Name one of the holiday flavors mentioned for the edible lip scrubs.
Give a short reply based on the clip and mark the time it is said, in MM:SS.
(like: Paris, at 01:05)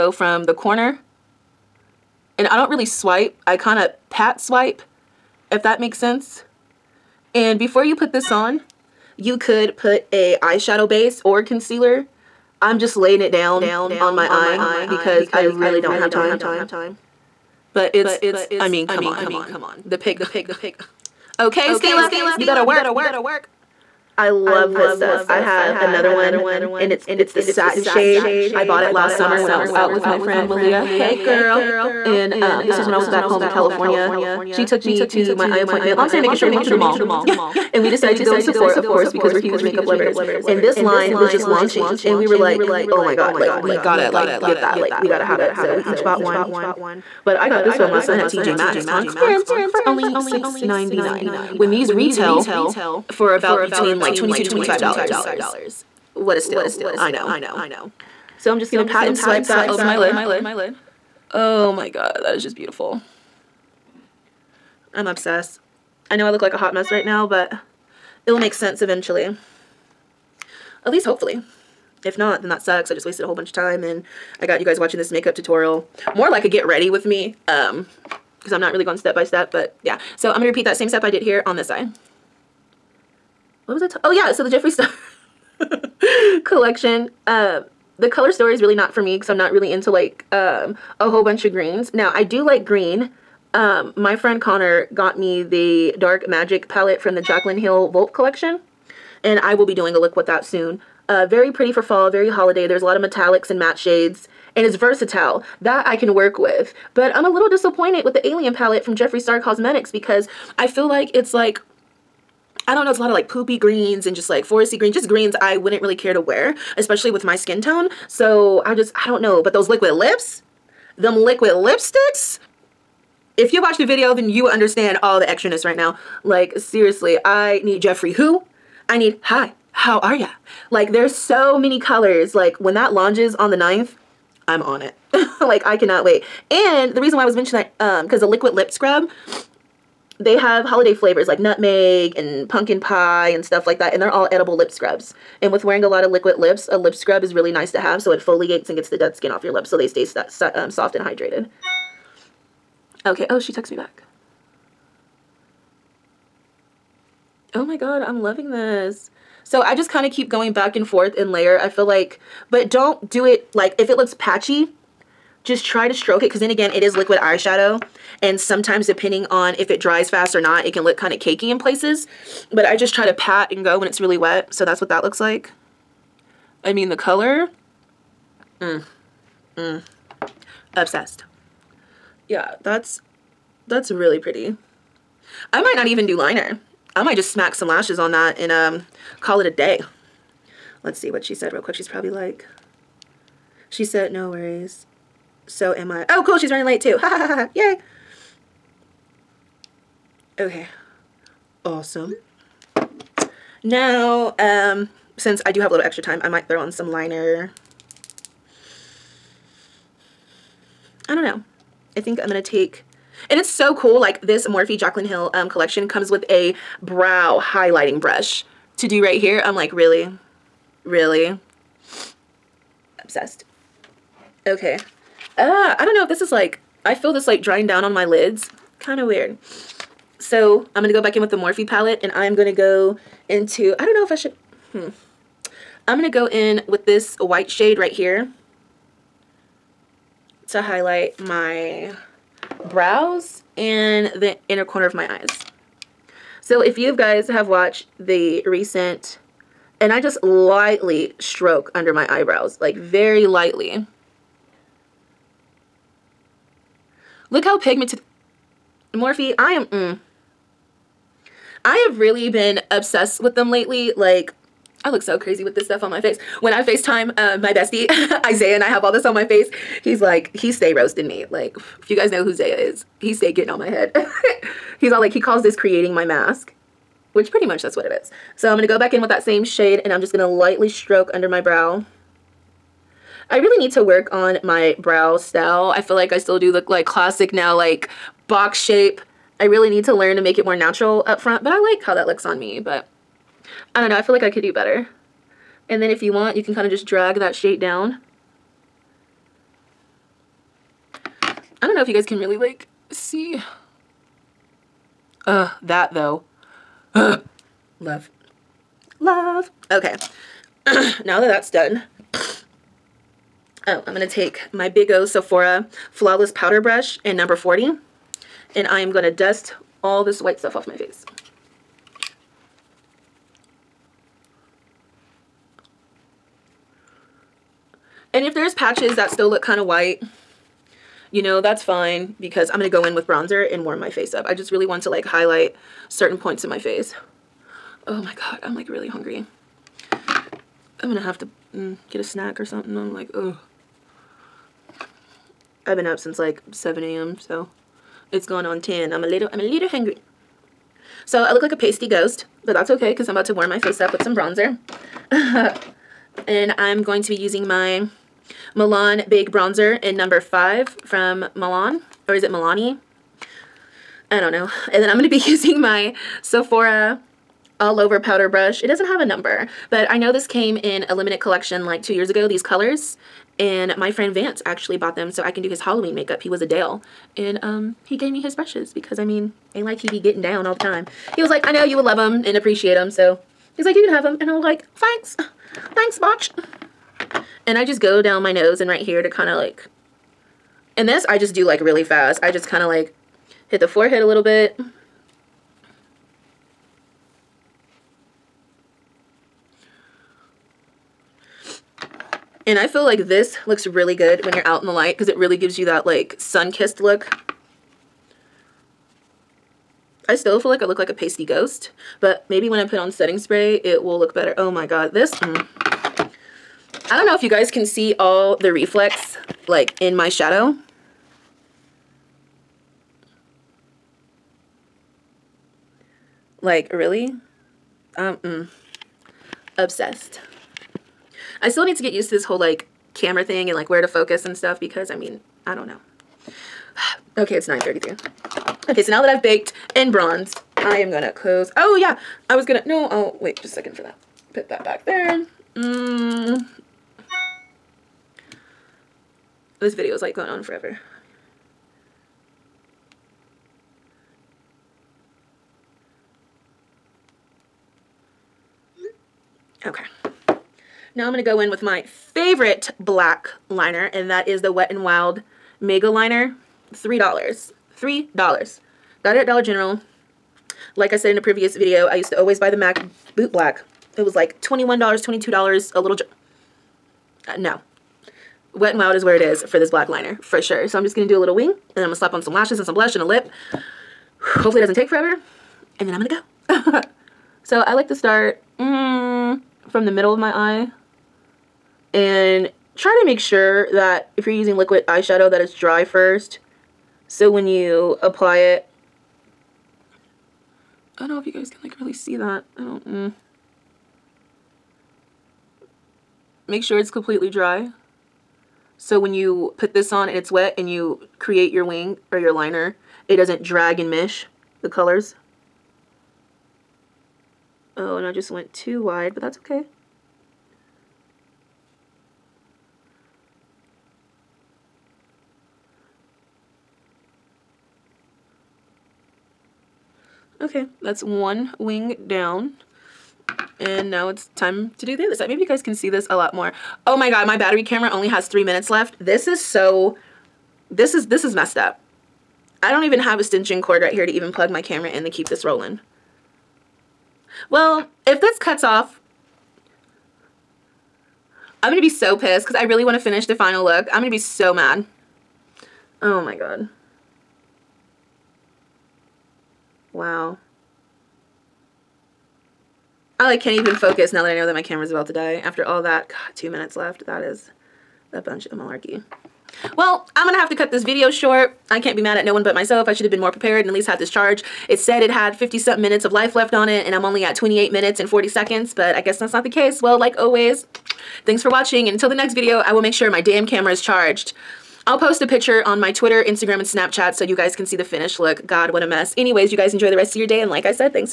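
nutmeg, at 02:21.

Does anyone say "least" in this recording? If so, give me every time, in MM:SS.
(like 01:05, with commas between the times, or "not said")
01:10, 09:33.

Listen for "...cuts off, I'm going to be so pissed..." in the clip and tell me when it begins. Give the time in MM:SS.
09:08.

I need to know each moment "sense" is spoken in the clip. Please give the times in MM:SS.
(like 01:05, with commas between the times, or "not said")
00:05, 01:08.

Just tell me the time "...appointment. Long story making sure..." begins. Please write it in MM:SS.
00:35.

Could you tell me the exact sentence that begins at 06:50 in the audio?
I still feel like I look like a pasty ghost, but maybe when I put on setting spray, it will look better.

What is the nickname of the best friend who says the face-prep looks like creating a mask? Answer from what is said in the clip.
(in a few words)
Zaya.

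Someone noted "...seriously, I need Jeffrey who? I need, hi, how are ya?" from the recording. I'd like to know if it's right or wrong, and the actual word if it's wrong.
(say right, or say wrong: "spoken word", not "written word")
right.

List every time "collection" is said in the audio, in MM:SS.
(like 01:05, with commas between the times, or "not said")
01:26, 01:38, 03:35, 06:11.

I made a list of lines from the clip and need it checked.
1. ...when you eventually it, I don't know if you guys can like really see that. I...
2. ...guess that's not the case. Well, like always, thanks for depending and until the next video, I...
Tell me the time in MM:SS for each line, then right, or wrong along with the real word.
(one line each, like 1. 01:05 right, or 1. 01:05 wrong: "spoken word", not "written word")
1. 08:17 wrong: "apply", not "eventually"
2. 09:38 wrong: "watching", not "depending".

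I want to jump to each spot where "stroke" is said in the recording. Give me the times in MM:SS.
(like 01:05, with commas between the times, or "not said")
02:45, 04:11, 04:40.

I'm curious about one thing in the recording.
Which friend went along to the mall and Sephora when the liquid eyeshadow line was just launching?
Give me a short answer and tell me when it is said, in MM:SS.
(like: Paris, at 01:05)
Malia, at 00:30.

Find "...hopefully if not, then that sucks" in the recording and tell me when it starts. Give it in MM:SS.
01:11.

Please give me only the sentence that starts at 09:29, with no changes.
Well, I'm going to have to cut this video short.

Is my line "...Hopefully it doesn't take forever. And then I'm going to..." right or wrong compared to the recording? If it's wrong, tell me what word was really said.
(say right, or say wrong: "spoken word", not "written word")
right.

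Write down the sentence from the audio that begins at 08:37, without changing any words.
Oh, and I just went too wide, but that's okay.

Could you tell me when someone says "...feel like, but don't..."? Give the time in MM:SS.
02:41.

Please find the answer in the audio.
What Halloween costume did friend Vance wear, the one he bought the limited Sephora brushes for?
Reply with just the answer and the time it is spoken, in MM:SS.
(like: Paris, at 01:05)
Dale, at 06:16.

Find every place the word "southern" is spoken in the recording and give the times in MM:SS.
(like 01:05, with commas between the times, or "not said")
not said.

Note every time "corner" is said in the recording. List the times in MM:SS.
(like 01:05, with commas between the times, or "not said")
00:00, 04:04.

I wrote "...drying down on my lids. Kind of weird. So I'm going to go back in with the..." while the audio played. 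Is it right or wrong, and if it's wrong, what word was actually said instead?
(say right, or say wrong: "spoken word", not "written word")
right.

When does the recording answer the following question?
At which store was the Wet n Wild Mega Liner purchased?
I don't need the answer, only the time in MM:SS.
07:49.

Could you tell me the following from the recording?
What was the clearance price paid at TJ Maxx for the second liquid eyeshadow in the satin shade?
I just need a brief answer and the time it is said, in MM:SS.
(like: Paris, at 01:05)
$6.99, at 00:50.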